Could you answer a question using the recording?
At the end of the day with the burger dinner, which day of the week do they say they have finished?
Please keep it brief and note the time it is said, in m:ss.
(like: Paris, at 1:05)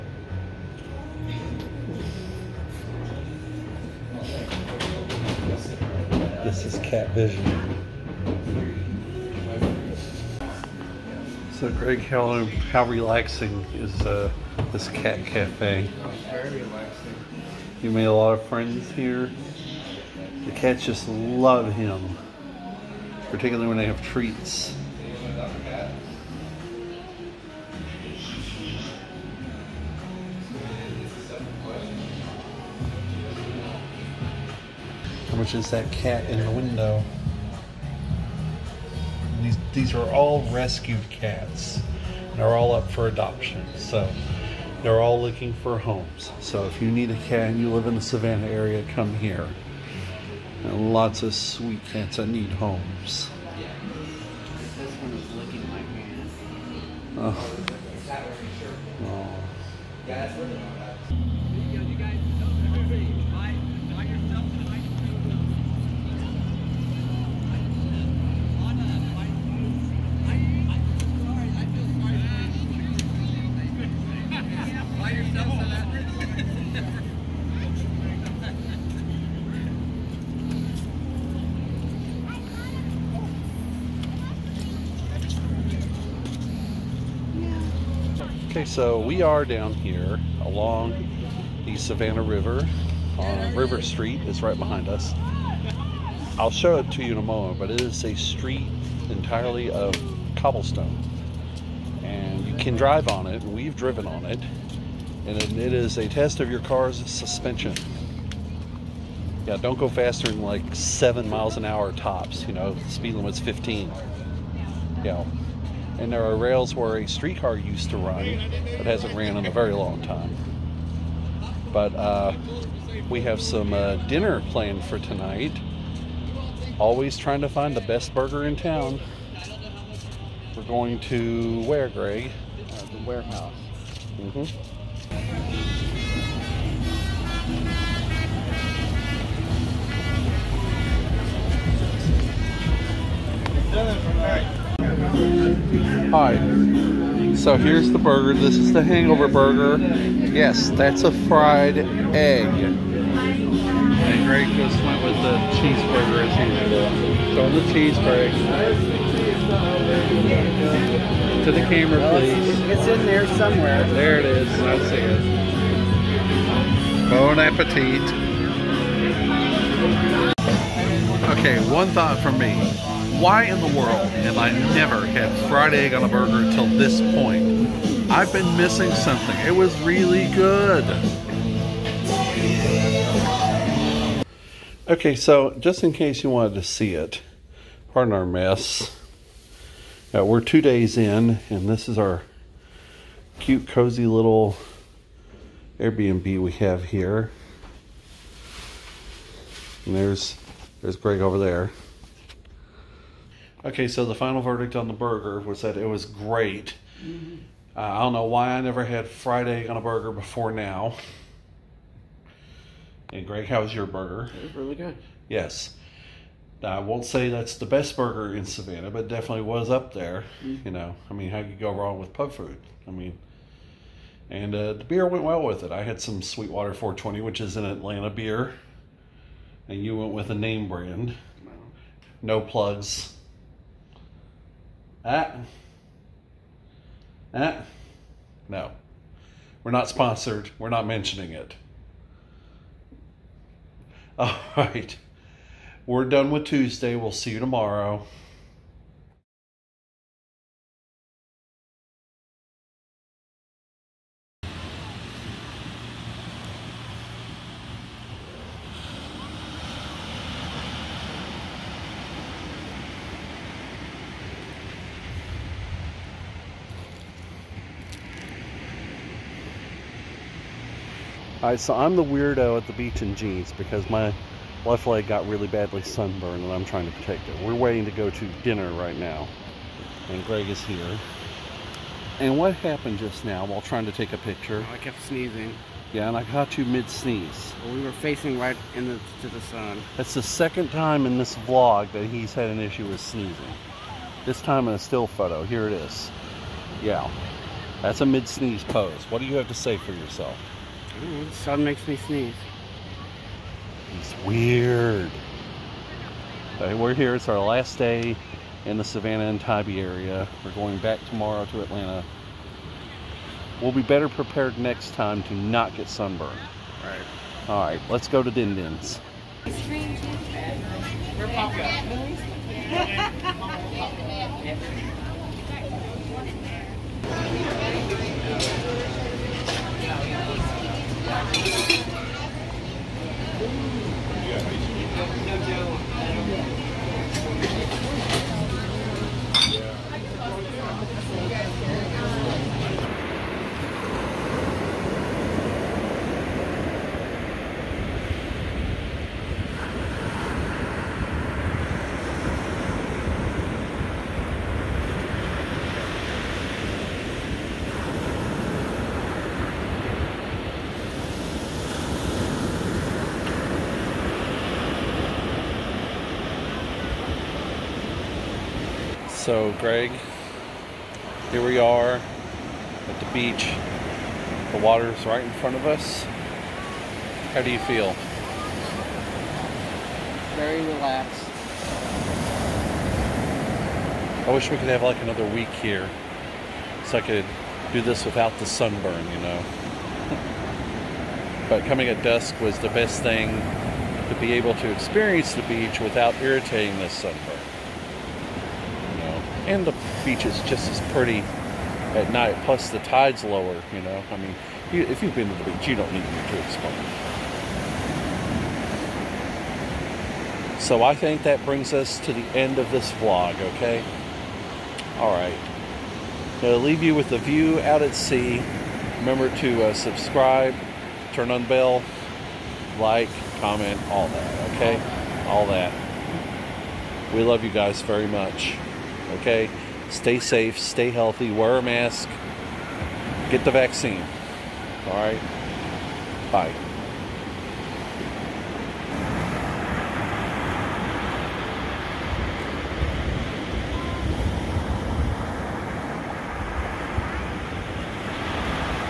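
Tuesday, at 4:06.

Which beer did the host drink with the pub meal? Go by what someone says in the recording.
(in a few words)
Sweetwater 420.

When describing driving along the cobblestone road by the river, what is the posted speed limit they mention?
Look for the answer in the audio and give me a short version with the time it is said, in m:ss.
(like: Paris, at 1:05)
15, at 1:52.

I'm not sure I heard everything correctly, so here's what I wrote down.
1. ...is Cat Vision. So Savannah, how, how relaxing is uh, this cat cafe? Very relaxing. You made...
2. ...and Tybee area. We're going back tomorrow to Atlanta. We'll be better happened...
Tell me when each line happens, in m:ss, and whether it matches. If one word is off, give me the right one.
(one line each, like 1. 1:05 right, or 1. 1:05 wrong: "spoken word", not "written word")
1. 0:06 wrong: "Greg", not "Savannah"
2. 5:09 wrong: "prepared", not "happened".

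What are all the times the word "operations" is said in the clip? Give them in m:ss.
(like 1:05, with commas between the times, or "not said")
not said.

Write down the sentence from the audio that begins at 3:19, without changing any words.
And there's there's Greg over there.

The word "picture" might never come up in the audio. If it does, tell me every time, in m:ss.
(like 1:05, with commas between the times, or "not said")
4:44.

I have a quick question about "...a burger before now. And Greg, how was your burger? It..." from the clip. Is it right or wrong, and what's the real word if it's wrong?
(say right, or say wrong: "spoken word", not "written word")
right.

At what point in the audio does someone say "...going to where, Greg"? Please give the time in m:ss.
2:10.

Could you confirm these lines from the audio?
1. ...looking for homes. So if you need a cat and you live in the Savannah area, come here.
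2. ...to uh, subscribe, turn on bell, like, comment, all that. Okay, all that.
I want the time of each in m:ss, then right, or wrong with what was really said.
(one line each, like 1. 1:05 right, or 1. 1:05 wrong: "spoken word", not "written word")
1. 0:45 right
2. 6:59 right.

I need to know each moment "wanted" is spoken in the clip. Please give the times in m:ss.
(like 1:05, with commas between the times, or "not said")
3:06.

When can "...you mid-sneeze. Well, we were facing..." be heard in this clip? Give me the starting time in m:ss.
4:46.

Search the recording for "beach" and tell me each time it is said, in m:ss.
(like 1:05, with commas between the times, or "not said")
4:32, 6:13, 6:35, 6:40, 6:45.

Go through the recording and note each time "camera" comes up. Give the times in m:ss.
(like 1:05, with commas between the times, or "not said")
2:41.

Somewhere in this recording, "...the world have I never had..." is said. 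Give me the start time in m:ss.
2:53.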